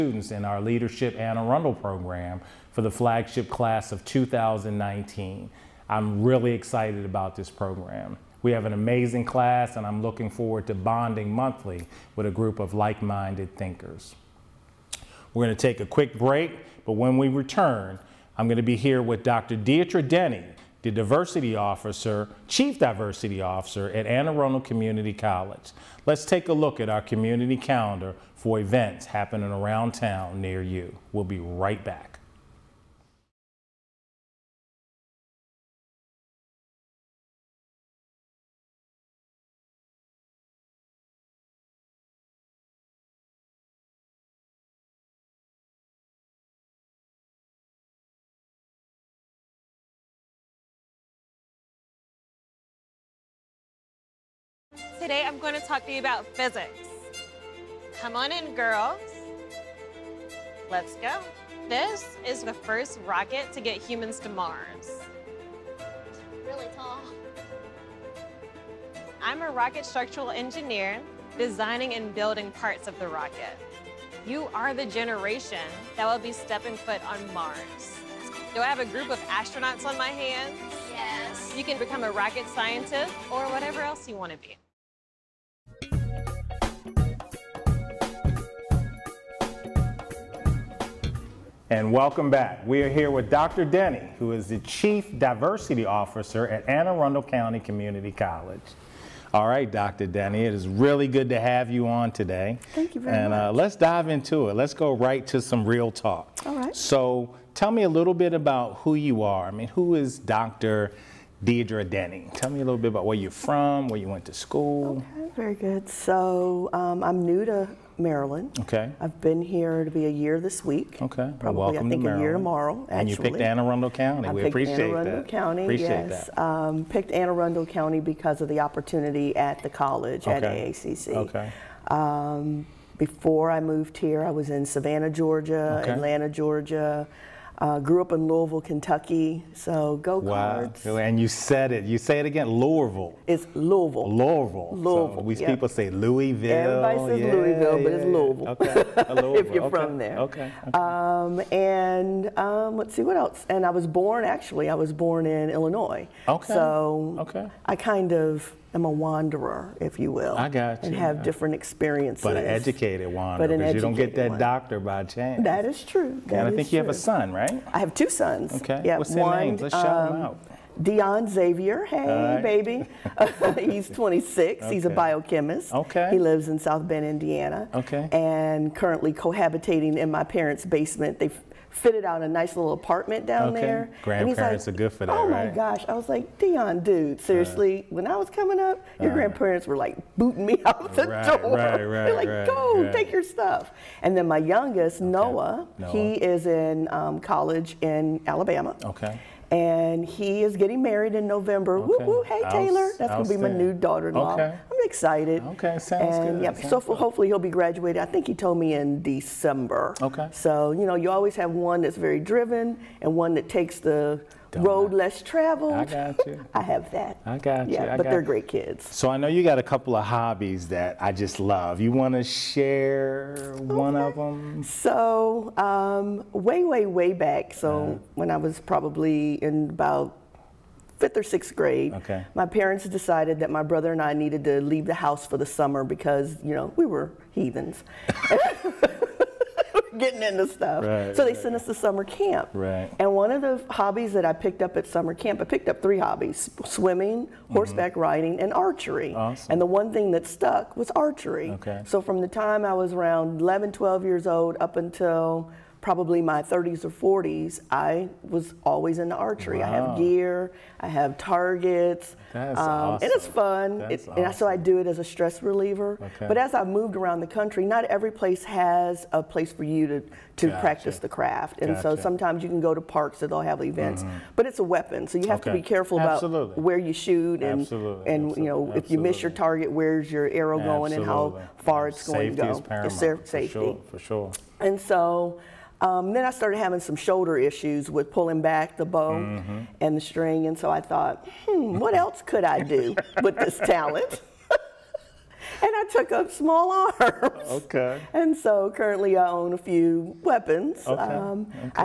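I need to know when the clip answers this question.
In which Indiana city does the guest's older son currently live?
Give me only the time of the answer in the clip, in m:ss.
2:56.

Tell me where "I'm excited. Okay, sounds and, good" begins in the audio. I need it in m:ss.
3:24.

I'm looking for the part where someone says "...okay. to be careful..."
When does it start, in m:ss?
4:35.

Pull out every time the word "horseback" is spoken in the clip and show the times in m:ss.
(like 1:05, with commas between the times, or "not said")
4:07.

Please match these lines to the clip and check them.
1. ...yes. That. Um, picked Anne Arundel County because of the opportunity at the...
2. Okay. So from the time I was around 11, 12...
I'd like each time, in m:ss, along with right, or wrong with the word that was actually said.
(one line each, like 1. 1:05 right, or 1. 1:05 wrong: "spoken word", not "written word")
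1. 2:06 right
2. 4:11 right.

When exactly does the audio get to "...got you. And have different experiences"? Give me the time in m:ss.
2:40.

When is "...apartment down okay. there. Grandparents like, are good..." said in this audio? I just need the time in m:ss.
3:02.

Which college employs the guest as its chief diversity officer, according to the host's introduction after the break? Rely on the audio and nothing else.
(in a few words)
Anne Arundel Community College.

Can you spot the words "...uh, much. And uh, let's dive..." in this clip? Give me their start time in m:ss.
1:43.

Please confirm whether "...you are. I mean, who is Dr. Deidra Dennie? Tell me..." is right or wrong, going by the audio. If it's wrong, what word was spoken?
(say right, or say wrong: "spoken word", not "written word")
right.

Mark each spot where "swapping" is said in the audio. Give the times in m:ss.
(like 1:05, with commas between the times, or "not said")
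not said.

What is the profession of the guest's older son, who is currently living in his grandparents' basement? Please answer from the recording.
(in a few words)
Biochemist.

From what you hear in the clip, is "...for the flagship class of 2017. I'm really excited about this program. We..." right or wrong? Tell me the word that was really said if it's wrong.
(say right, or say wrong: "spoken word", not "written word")
wrong: "2019", not "2017".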